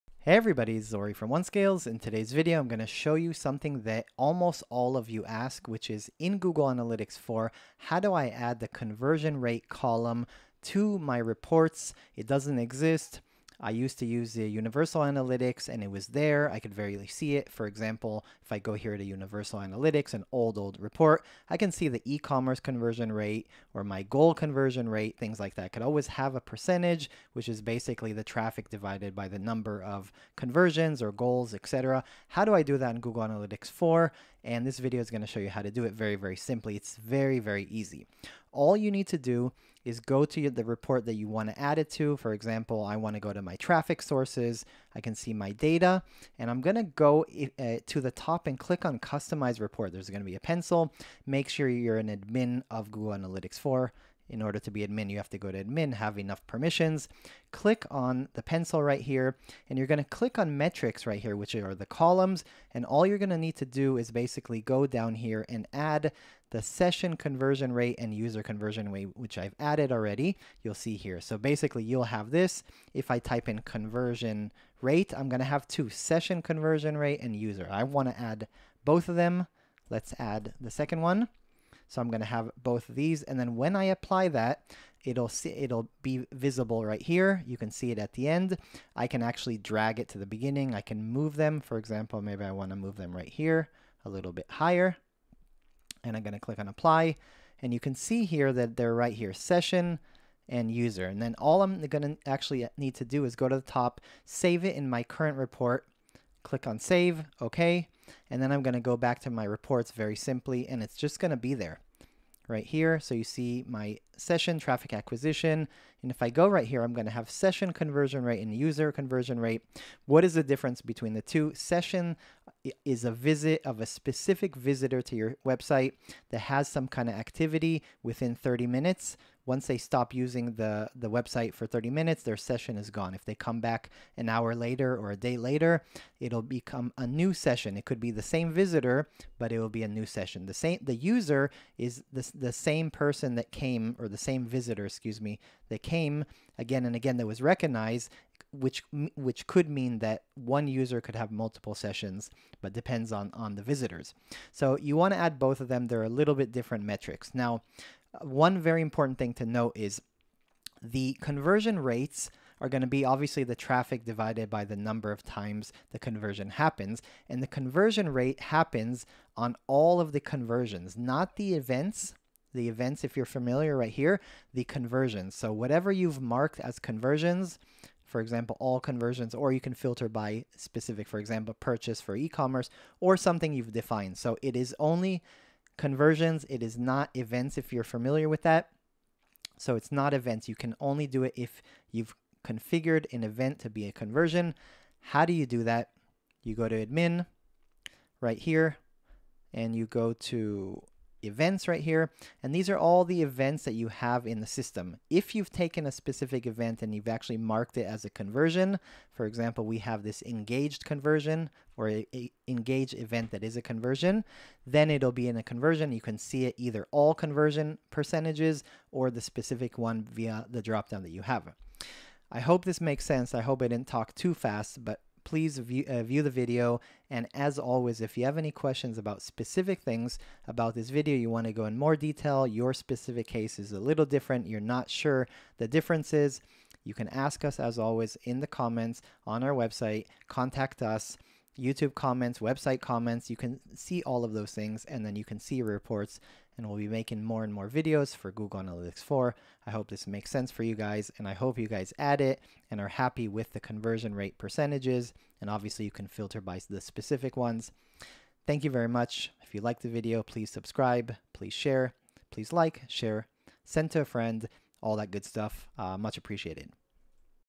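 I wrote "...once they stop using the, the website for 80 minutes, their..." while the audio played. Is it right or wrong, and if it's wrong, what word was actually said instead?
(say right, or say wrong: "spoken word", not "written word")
wrong: "30", not "80".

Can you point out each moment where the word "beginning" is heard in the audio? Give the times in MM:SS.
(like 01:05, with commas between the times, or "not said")
01:30.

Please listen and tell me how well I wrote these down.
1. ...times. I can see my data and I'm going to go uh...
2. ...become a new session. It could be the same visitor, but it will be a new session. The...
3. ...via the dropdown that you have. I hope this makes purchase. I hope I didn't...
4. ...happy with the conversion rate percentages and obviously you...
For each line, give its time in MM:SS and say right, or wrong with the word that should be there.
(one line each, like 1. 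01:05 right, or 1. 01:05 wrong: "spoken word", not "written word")
1. 00:44 wrong: "sources", not "times"
2. 02:16 right
3. 03:40 wrong: "sense", not "purchase"
4. 04:12 right.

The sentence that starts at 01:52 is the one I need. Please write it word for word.
So you see my session traffic acquisition.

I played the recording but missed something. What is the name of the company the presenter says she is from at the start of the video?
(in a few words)
OneScales.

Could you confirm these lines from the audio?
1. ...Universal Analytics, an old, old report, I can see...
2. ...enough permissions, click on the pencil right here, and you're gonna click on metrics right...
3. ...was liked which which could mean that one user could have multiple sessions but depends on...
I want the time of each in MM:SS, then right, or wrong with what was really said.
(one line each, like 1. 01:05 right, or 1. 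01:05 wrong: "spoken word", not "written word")
1. 00:19 right
2. 00:56 right
3. 02:27 wrong: "recognized", not "liked".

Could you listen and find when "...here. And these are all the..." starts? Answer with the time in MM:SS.
03:21.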